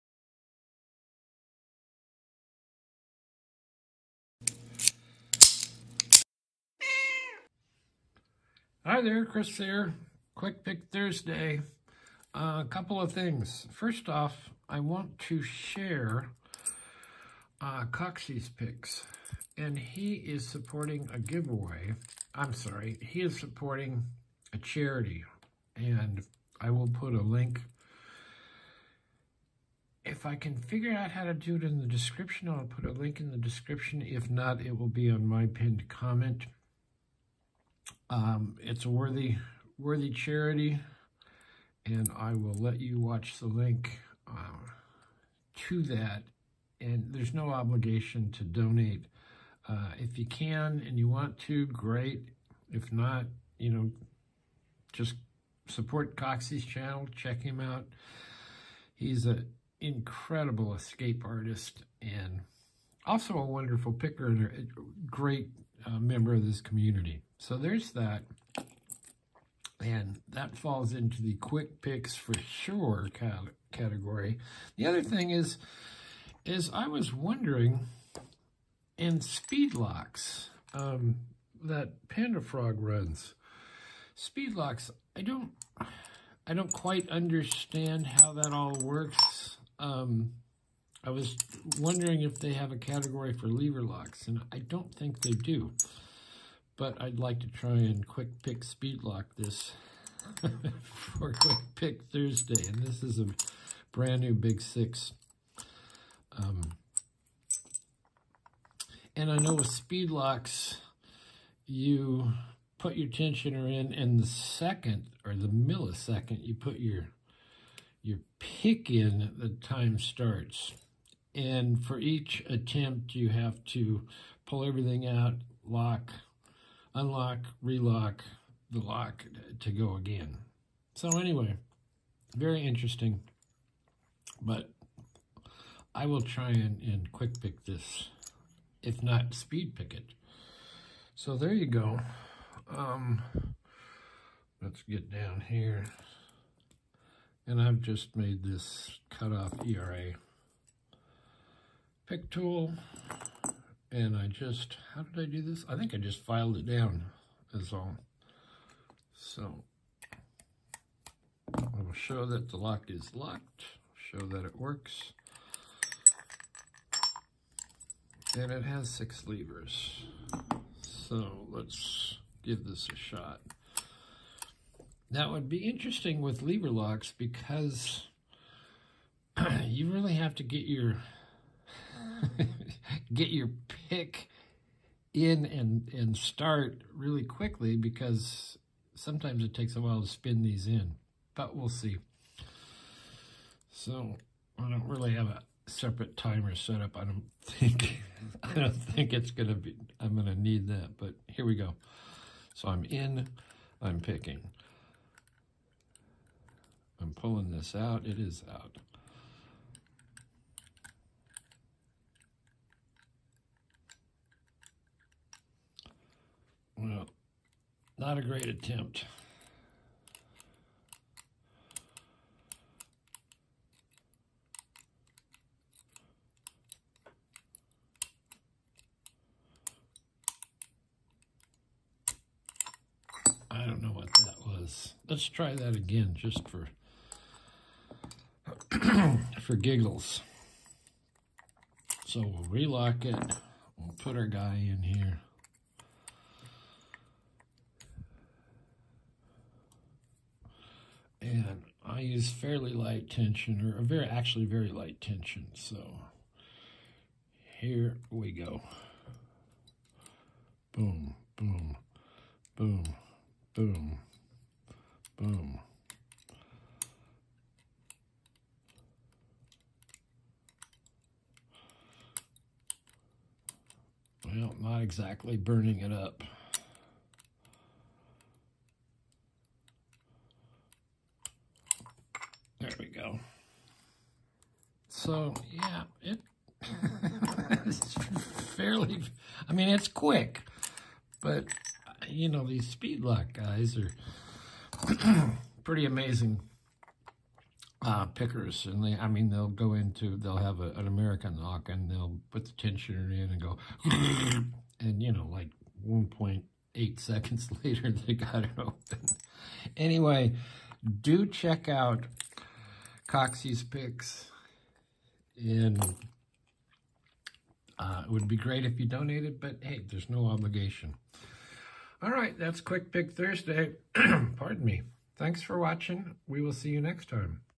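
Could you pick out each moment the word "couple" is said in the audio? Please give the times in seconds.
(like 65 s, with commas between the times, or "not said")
12 s.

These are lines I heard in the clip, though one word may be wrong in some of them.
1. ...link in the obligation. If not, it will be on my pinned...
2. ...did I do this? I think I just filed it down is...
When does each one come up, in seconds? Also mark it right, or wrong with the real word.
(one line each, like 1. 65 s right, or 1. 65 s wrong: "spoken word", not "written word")
1. 32 s wrong: "description", not "obligation"
2. 155 s right.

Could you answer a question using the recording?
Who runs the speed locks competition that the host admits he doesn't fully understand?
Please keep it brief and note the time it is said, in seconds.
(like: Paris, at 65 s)
Panda Frog, at 82 s.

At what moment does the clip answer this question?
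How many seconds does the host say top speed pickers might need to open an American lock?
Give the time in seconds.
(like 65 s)
305 s.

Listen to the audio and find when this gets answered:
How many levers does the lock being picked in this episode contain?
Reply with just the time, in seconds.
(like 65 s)
168 s.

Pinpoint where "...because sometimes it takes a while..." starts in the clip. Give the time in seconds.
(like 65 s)
187 s.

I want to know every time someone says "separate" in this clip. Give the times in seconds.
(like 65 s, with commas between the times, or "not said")
195 s.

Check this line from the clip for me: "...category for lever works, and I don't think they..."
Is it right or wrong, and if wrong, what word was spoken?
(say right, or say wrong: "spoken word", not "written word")
wrong: "locks", not "works".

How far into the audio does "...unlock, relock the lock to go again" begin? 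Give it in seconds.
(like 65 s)
126 s.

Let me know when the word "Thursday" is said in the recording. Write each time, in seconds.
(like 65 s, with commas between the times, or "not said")
10 s, 102 s, 323 s.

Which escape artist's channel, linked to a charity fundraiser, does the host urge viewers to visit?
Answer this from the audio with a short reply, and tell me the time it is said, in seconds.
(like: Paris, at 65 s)
Coxey's Picks, at 17 s.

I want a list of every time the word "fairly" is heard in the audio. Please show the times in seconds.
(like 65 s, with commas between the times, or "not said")
252 s, 288 s.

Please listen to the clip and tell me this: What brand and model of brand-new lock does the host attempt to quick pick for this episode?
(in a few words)
Big Six.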